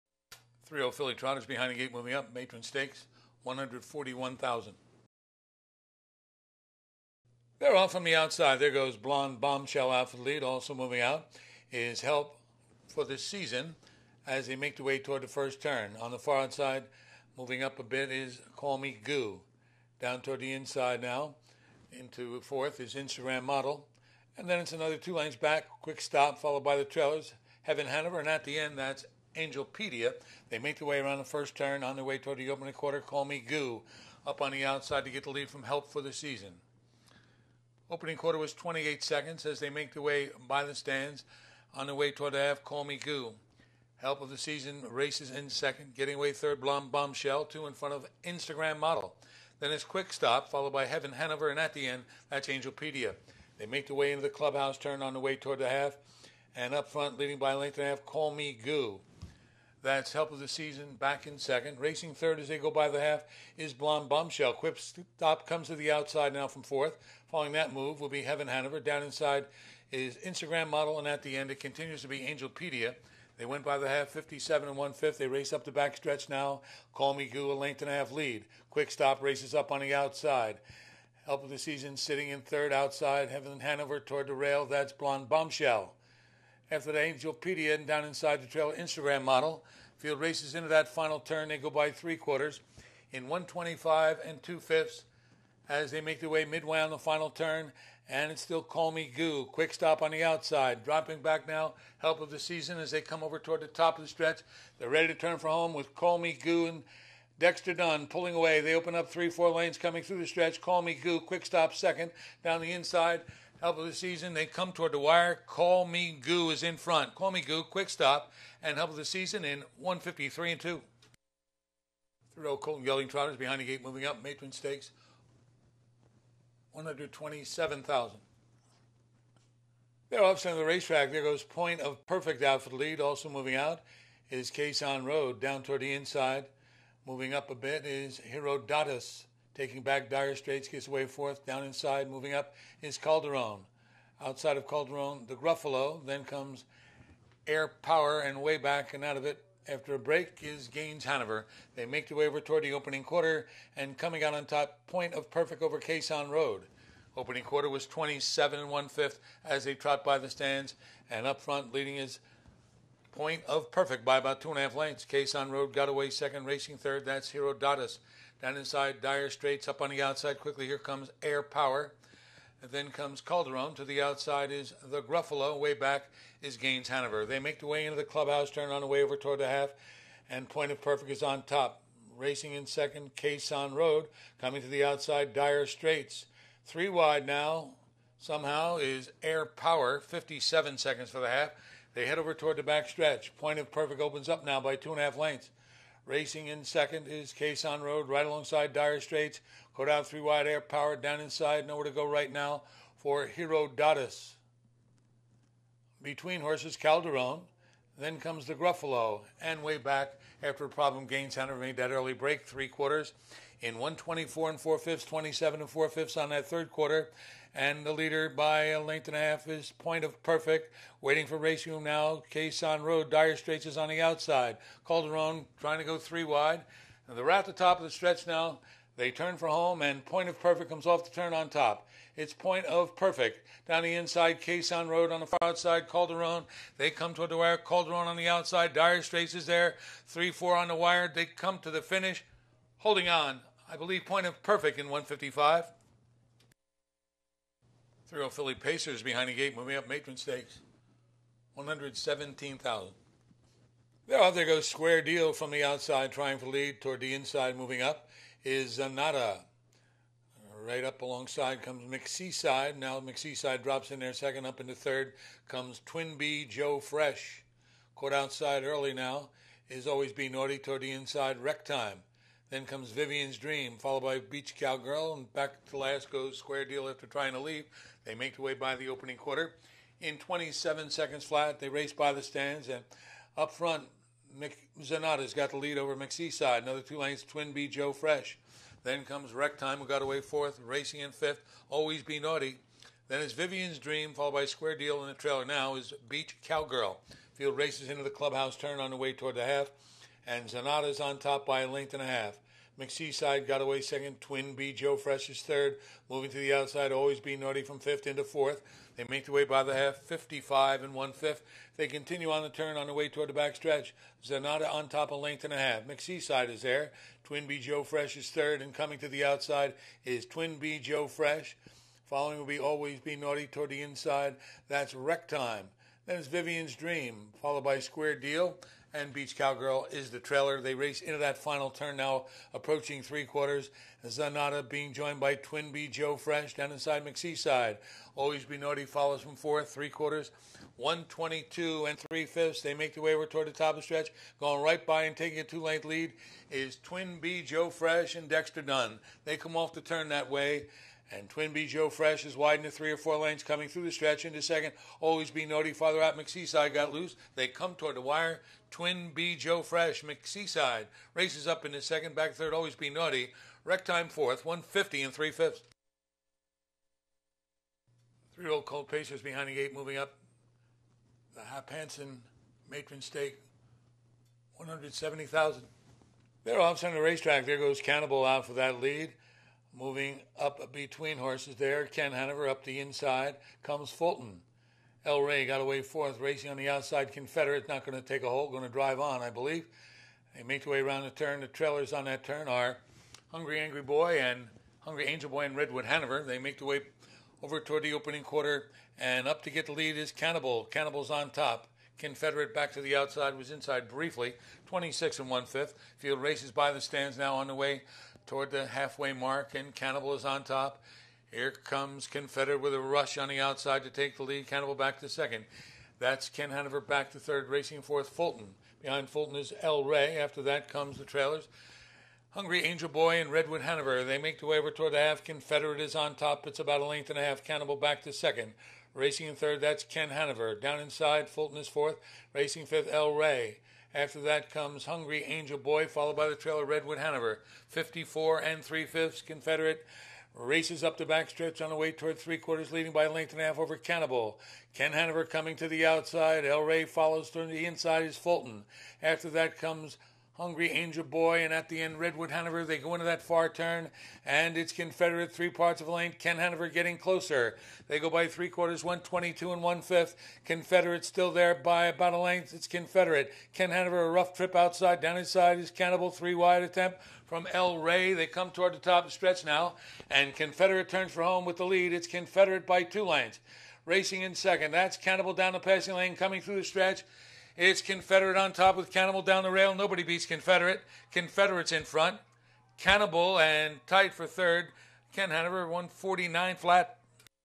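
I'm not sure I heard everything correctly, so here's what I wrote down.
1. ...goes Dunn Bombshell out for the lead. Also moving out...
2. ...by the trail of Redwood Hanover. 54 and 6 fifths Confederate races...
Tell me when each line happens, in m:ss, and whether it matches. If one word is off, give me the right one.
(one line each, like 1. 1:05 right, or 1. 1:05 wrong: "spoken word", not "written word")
1. 0:08 wrong: "Blonde", not "Dunn"
2. 7:16 wrong: "3", not "6".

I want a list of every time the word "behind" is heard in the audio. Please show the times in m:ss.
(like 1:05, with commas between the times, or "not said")
0:01, 2:03, 4:09, 6:09, 6:58.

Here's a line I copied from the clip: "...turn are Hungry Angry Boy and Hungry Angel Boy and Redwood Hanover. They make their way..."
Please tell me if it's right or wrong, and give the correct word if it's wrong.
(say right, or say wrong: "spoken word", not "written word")
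right.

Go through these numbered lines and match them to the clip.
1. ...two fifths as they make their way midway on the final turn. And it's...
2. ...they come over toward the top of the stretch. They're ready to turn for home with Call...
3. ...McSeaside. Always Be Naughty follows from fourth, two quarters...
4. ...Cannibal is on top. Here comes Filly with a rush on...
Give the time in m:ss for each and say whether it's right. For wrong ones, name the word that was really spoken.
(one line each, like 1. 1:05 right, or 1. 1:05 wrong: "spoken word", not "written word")
1. 1:34 right
2. 1:42 right
3. 5:37 wrong: "three", not "two"
4. 6:49 wrong: "Confederate", not "Filly".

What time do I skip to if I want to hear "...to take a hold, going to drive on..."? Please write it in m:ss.
6:27.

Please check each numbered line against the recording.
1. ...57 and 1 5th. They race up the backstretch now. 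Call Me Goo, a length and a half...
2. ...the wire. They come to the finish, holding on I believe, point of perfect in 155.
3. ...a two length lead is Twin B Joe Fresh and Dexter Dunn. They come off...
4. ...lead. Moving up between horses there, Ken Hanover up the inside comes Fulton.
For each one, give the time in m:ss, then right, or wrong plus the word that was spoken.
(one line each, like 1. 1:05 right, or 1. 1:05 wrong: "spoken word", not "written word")
1. 1:14 right
2. 4:00 right
3. 5:45 right
4. 6:18 right.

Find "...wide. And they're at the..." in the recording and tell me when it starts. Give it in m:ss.
3:46.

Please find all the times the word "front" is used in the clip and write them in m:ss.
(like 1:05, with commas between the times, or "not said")
0:47, 0:56, 1:56, 2:41, 4:43, 8:01.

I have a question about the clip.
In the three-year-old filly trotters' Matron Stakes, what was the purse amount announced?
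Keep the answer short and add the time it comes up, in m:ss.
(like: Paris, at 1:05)
$141,000, at 0:03.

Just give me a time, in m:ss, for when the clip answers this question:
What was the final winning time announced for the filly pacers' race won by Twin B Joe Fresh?
6:04.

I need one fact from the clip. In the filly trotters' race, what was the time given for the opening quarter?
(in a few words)
28 seconds.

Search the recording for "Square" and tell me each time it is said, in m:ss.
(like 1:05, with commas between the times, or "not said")
4:14, 4:36, 4:54, 5:27.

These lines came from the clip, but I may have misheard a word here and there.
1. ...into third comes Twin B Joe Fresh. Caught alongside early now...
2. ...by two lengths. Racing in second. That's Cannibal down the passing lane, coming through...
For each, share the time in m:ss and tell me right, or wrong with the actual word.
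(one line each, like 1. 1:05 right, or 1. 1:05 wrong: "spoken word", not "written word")
1. 4:24 wrong: "outside", not "alongside"
2. 7:52 right.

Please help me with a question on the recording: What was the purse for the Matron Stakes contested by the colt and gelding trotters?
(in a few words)
$127,000.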